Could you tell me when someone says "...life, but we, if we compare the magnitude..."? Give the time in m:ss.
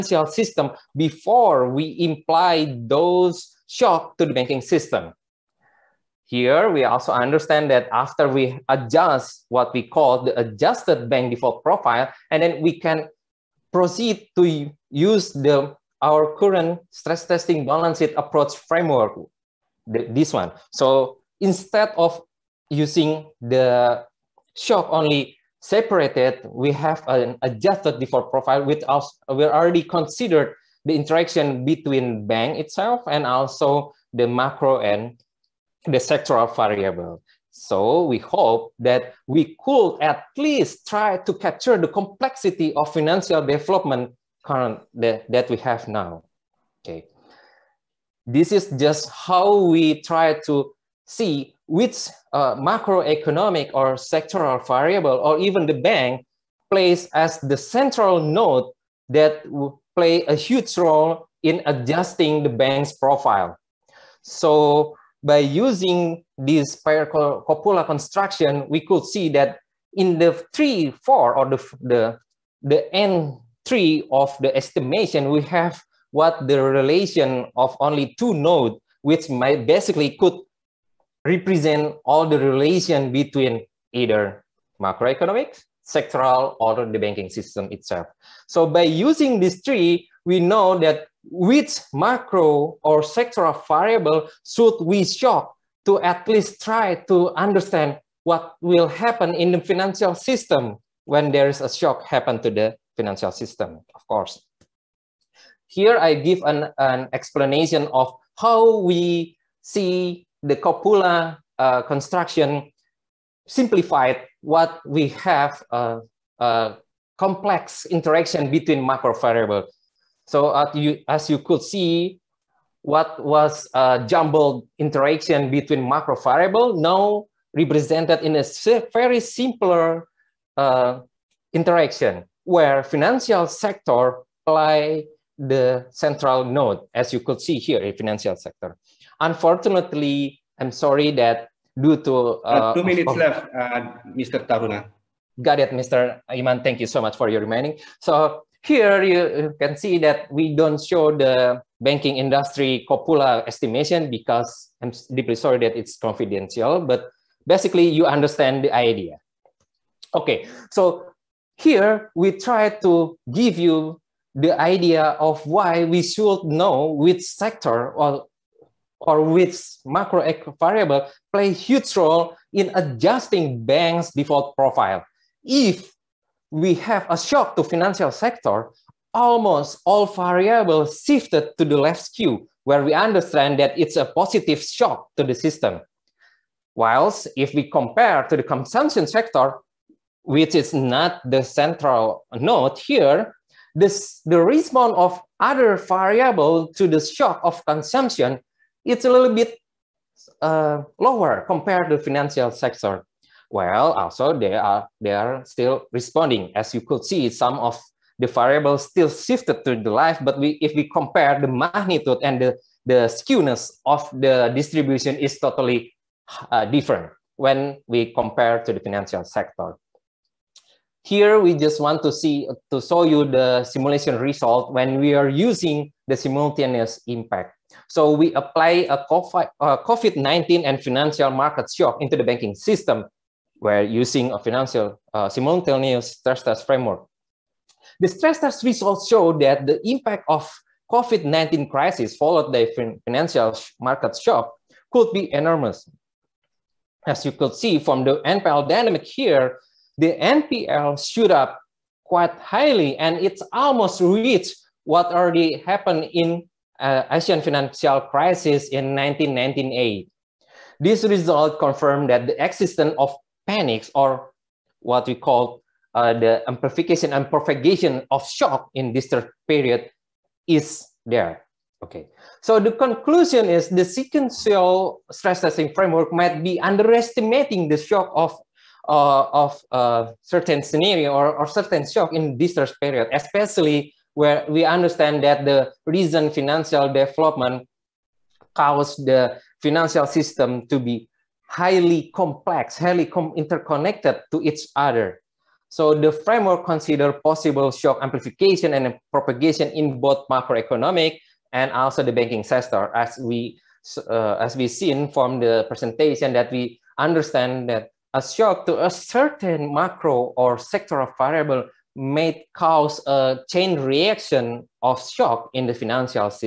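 3:29.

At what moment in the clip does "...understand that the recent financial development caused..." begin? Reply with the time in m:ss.
4:44.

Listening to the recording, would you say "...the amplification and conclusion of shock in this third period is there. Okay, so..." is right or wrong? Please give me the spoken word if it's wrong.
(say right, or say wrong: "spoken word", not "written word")
wrong: "propagation", not "conclusion".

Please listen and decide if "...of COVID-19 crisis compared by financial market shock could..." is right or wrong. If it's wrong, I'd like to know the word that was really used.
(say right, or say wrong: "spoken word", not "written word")
wrong: "followed", not "compared".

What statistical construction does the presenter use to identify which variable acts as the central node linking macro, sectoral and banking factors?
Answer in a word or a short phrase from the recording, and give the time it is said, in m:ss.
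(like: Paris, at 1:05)
Pair copula construction, at 1:06.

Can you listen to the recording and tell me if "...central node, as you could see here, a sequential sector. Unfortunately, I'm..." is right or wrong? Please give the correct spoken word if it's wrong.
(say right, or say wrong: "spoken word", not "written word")
wrong: "financial", not "sequential".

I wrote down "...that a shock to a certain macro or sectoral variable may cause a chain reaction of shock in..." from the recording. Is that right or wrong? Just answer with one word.
right.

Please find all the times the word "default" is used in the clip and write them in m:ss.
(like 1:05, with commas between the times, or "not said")
0:11, 0:27, 2:54.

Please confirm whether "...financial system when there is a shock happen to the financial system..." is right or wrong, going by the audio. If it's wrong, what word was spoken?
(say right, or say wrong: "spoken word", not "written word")
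right.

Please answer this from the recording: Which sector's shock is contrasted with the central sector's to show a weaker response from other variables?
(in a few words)
Consumption sector.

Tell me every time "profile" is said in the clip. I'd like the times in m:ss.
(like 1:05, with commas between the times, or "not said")
0:11, 0:28, 1:02, 2:54.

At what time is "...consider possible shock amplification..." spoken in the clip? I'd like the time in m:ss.
4:56.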